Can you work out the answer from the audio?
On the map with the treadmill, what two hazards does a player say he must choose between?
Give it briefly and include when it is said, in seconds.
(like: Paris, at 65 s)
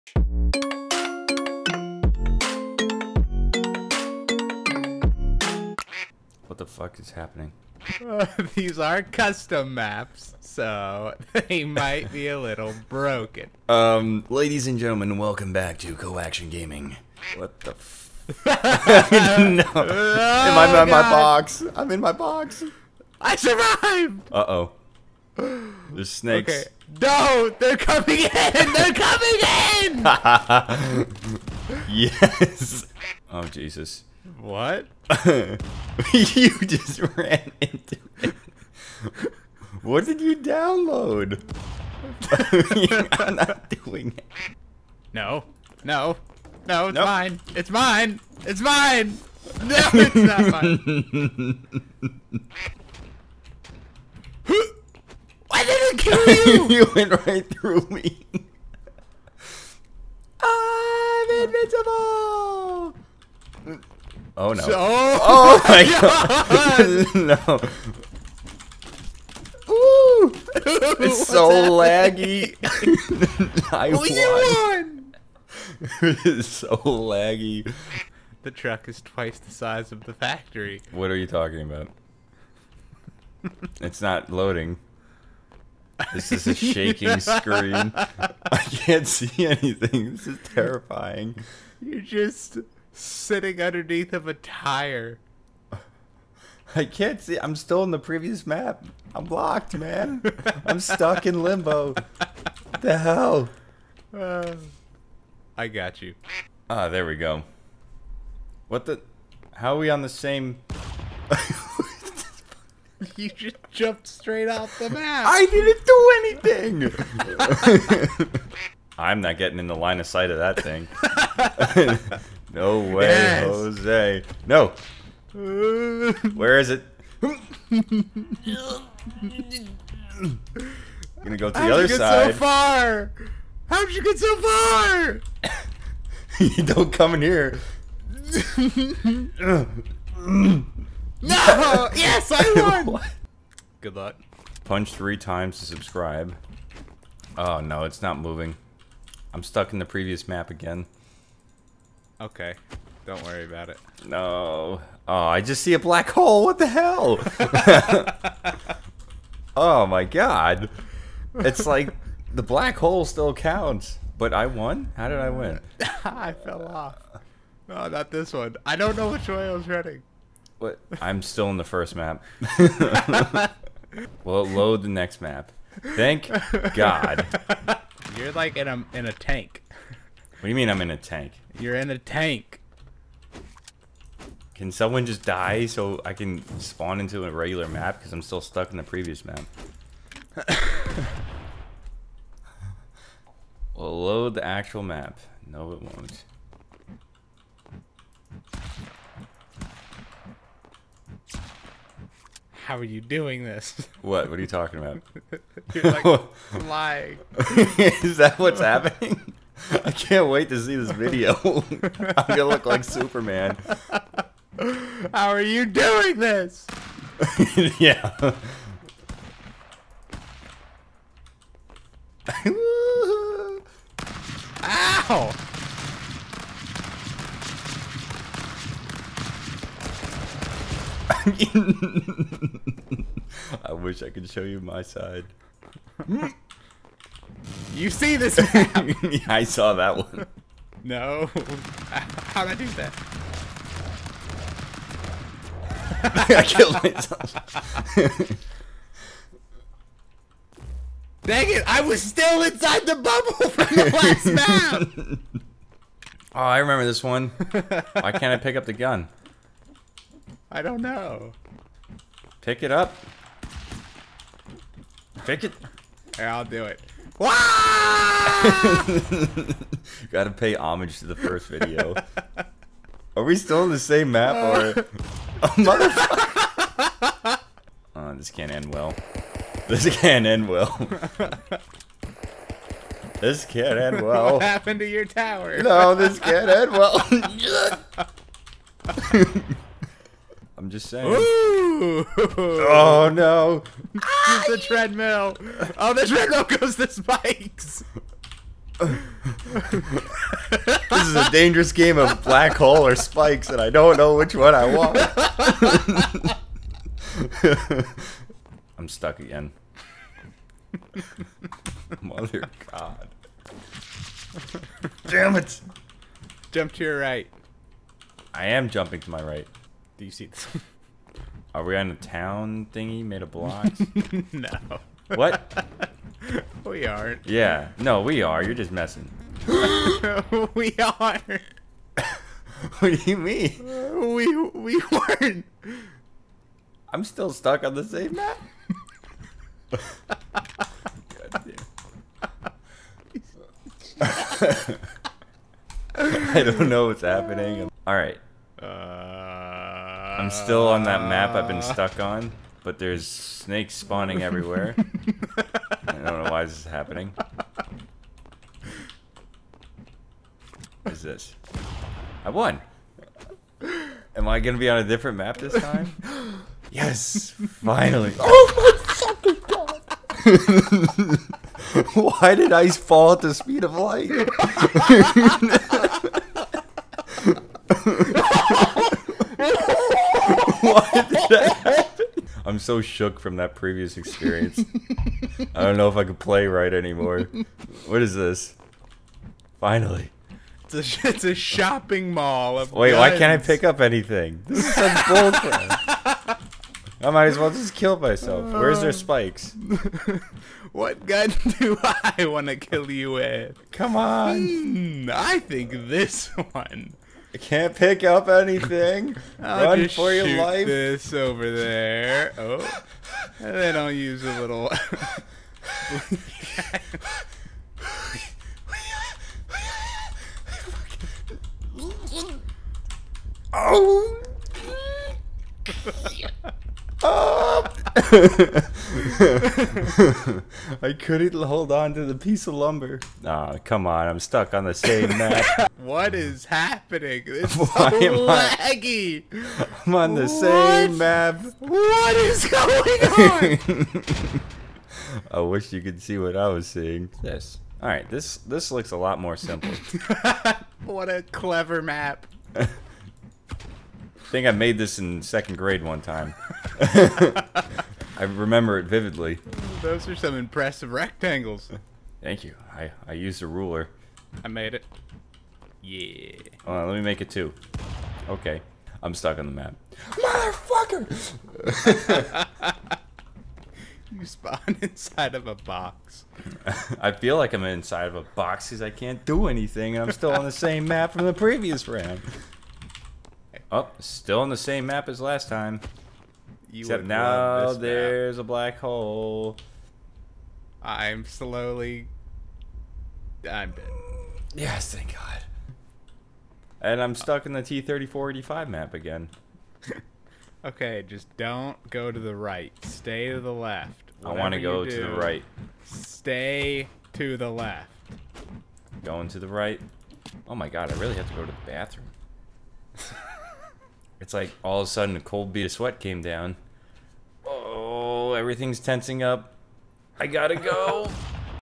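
black hole or spikes, at 302 s.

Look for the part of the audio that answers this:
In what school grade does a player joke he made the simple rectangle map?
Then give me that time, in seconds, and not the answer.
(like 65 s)
455 s.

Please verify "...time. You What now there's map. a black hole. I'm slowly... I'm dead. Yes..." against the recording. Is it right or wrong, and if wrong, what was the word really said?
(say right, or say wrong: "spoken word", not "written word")
wrong: "Except", not "What".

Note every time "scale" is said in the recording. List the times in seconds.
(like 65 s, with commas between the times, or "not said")
not said.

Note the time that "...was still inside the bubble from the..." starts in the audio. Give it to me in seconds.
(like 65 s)
251 s.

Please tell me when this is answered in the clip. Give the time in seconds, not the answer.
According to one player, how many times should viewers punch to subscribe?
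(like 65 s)
144 s.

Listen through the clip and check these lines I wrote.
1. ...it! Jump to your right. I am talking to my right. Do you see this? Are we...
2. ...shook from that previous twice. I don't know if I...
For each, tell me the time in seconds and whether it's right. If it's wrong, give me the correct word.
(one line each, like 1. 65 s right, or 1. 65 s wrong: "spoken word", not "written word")
1. 315 s wrong: "jumping", not "talking"
2. 382 s wrong: "experience", not "twice".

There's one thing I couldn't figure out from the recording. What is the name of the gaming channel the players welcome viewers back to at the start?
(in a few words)
Co-Action Gaming.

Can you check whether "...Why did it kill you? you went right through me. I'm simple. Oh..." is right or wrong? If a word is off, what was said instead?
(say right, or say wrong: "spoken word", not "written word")
wrong: "invincible", not "simple".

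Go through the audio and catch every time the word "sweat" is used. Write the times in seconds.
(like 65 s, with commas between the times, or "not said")
515 s.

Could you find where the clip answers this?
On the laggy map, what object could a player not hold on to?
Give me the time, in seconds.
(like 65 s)
432 s.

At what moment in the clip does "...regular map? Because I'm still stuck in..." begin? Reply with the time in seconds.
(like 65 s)
187 s.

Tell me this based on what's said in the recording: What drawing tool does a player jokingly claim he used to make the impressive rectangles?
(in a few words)
a ruler.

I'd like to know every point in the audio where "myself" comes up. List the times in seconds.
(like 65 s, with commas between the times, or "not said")
246 s, 397 s.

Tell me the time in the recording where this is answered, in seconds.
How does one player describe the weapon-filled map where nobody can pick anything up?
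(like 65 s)
391 s.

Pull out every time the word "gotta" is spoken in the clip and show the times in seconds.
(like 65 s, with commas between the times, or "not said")
270 s, 520 s.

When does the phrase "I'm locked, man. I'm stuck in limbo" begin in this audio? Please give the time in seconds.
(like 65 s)
99 s.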